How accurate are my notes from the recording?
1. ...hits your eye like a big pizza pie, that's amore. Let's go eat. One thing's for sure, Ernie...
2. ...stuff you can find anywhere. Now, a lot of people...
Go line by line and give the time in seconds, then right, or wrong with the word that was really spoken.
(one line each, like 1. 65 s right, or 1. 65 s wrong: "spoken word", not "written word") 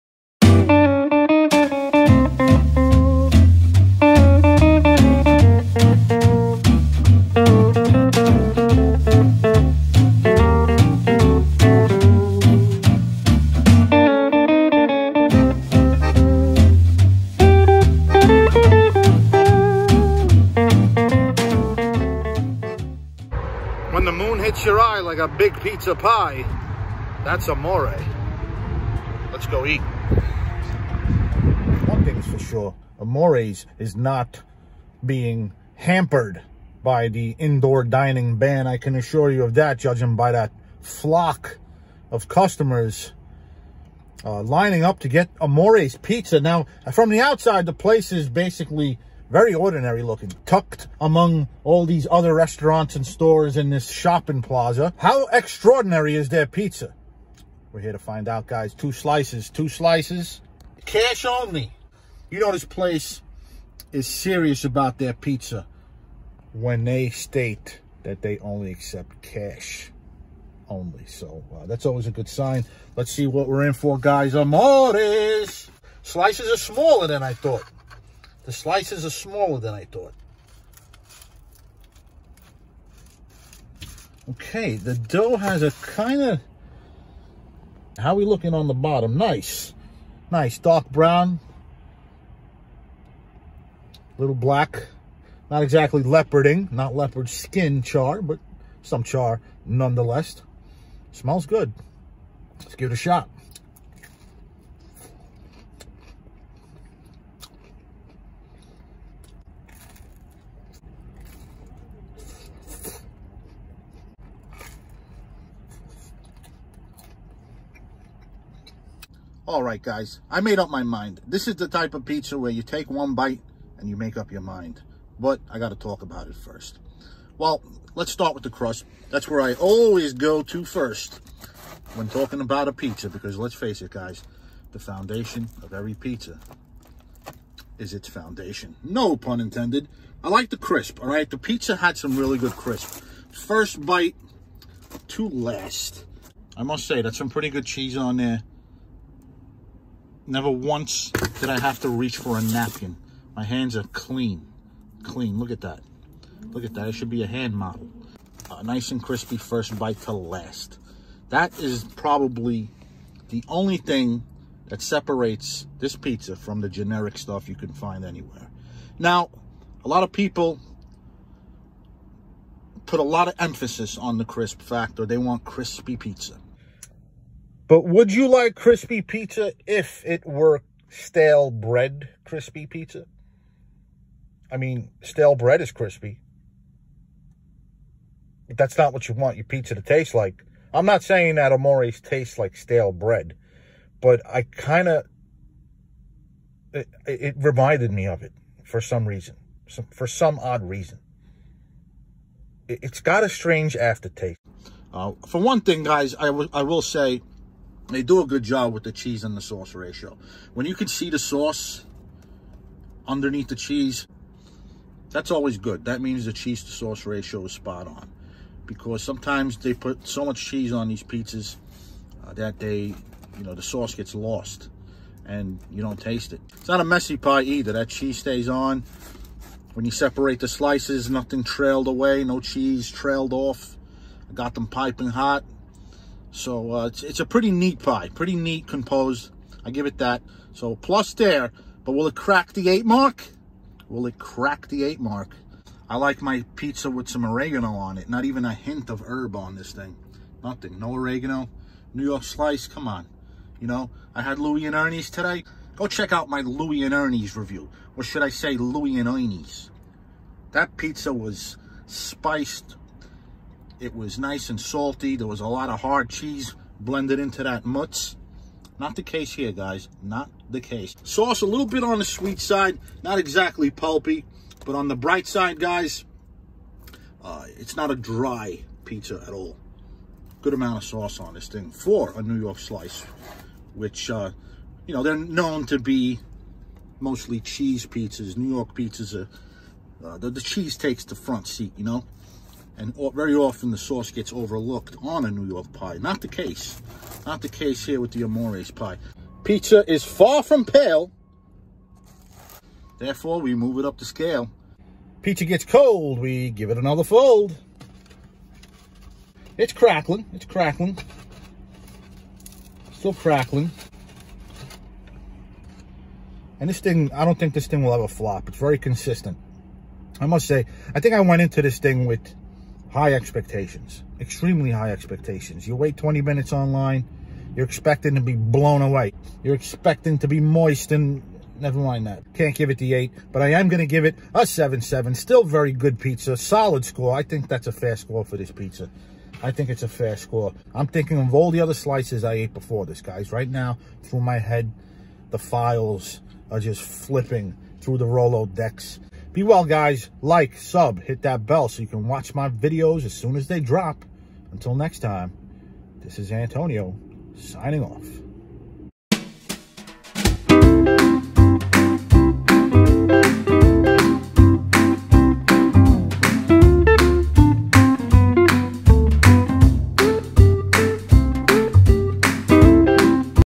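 1. 24 s wrong: "Amores", not "Ernie"
2. 167 s right.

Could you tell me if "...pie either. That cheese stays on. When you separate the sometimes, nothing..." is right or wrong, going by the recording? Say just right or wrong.
wrong.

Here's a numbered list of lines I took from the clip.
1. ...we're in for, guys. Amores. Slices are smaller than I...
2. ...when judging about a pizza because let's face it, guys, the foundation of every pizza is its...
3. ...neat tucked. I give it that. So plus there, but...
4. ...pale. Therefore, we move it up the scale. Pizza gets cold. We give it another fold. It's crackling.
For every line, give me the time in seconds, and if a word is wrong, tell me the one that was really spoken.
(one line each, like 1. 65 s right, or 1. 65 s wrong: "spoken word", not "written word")
1. 73 s right
2. 131 s wrong: "talking", not "judging"
3. 238 s wrong: "composed", not "tucked"
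4. 300 s right.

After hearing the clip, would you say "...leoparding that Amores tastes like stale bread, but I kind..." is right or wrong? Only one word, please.
wrong.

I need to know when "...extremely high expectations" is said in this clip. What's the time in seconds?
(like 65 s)
324 s.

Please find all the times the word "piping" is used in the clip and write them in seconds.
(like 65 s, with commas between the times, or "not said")
234 s.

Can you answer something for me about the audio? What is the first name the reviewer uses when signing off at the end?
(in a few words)
Antonio.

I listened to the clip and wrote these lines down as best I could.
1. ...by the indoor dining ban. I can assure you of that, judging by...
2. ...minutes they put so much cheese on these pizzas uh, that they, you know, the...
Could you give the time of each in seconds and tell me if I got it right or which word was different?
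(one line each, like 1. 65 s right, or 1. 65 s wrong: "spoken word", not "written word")
1. 36 s right
2. 219 s wrong: "sometimes", not "minutes".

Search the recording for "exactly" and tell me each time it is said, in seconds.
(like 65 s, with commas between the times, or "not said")
95 s, 273 s.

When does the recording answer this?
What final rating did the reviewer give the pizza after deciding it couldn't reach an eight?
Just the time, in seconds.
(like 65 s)
334 s.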